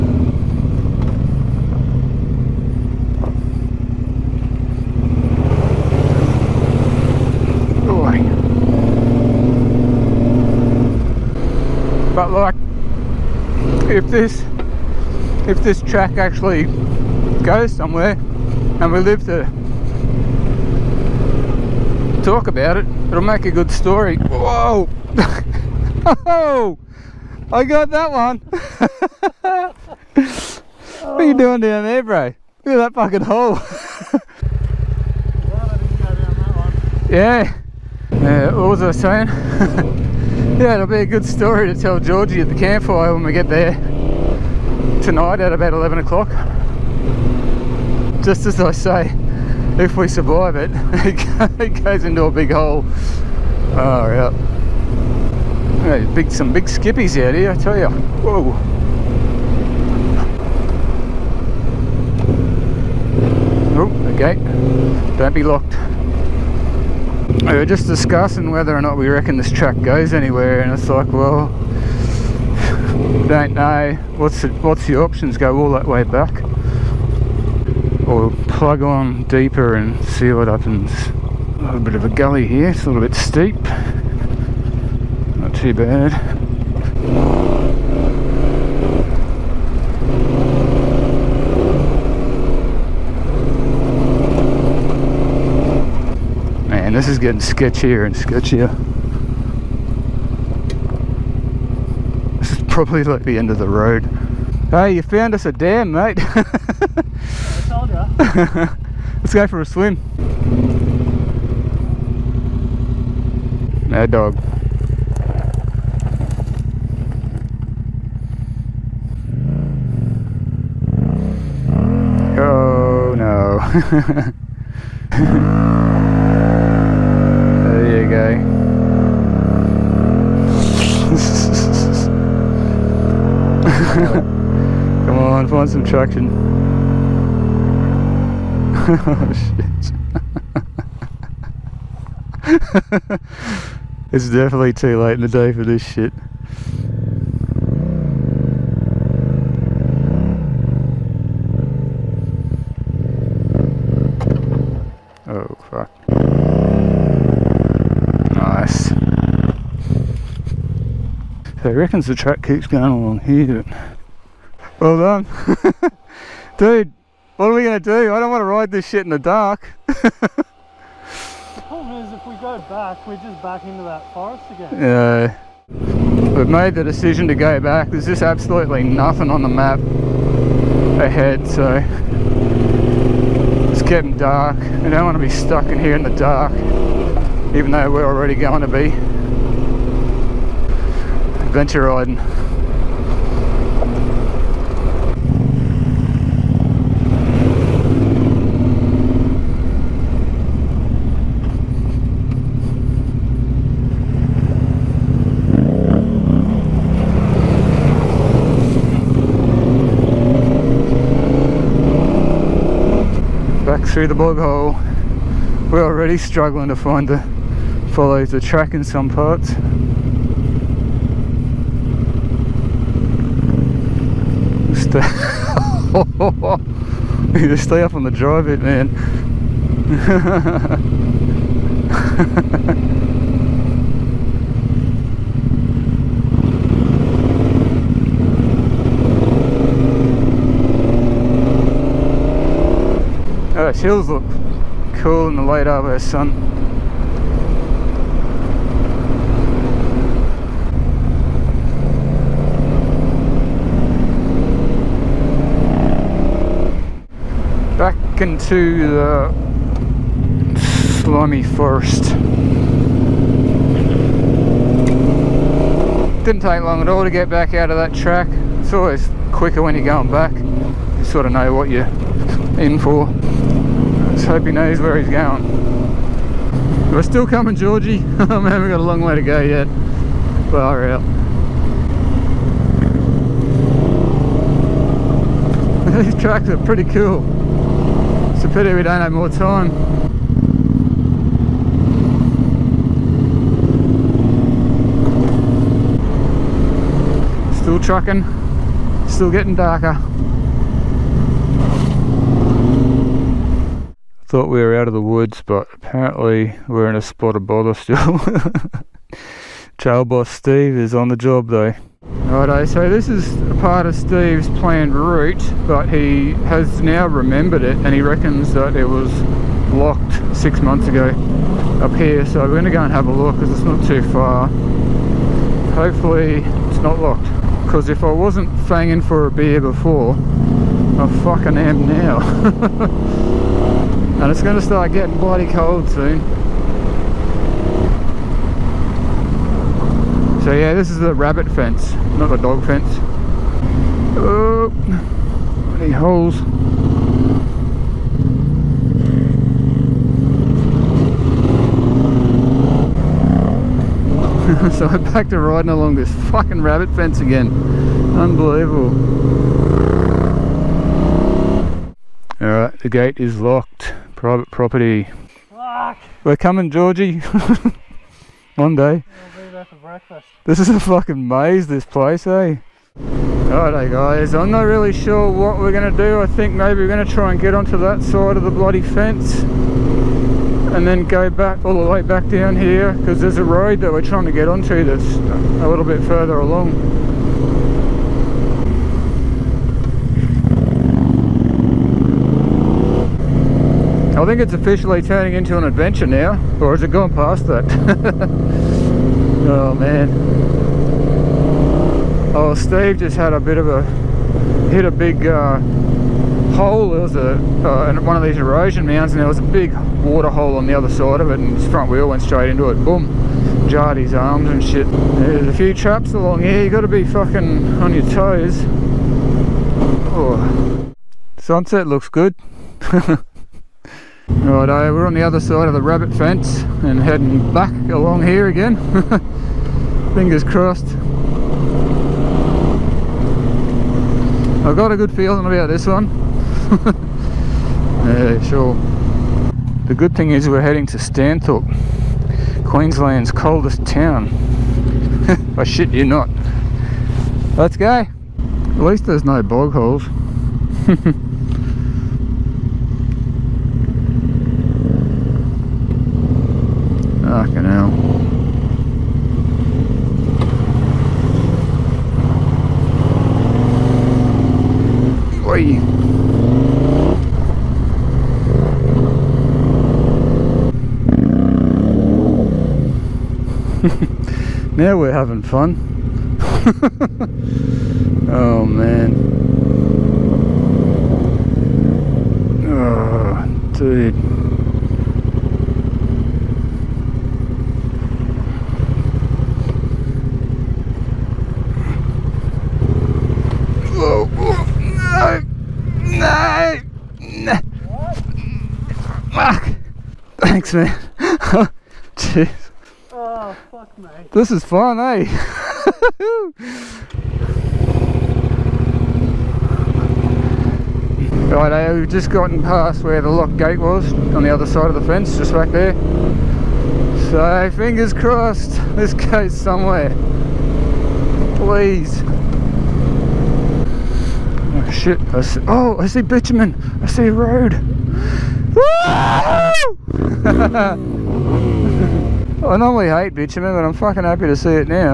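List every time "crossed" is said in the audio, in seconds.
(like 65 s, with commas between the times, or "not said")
430 s, 518 s.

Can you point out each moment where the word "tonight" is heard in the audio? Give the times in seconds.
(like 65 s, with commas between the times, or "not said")
45 s.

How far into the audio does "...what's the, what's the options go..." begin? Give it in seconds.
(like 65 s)
74 s.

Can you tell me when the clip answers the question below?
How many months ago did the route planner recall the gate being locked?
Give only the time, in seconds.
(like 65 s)
320 s.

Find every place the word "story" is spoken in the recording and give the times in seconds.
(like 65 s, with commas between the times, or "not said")
23 s, 41 s.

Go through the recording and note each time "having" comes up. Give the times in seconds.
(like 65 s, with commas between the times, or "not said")
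475 s.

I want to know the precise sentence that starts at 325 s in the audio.
Hopefully it's not locked because if I wasn't fanging for a beer before, I fucking am now.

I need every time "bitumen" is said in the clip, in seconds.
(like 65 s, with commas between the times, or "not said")
526 s, 533 s.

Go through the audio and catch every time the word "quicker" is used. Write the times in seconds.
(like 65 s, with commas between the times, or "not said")
269 s.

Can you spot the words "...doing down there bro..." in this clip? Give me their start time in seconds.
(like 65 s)
31 s.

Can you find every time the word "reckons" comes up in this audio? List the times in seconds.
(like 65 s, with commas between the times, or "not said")
69 s, 161 s, 318 s.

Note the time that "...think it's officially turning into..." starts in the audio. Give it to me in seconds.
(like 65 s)
394 s.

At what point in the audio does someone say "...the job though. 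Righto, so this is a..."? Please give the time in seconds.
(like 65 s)
311 s.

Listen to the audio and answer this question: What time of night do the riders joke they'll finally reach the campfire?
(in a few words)
11 o'clock.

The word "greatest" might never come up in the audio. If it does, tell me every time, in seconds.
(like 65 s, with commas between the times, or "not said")
not said.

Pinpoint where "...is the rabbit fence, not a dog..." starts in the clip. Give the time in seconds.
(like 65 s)
340 s.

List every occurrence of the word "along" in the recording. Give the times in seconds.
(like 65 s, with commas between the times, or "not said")
162 s, 355 s, 386 s, 416 s, 427 s.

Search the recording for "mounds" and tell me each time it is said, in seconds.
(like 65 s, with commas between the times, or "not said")
408 s.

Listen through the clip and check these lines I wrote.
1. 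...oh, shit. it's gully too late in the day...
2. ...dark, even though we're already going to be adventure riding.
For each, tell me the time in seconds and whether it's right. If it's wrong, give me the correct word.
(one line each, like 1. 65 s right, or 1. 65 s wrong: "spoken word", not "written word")
1. 143 s wrong: "definitely", not "gully"
2. 186 s right.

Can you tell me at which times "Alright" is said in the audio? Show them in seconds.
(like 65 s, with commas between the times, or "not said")
362 s, 373 s.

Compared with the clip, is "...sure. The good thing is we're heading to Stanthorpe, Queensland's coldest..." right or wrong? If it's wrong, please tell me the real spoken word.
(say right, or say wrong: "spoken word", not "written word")
right.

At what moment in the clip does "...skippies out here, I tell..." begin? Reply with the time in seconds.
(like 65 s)
56 s.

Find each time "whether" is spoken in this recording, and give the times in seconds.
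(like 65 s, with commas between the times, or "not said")
68 s.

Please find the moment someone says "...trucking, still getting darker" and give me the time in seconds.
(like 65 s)
297 s.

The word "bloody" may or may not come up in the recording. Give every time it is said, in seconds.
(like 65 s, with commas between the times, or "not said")
335 s, 345 s, 378 s.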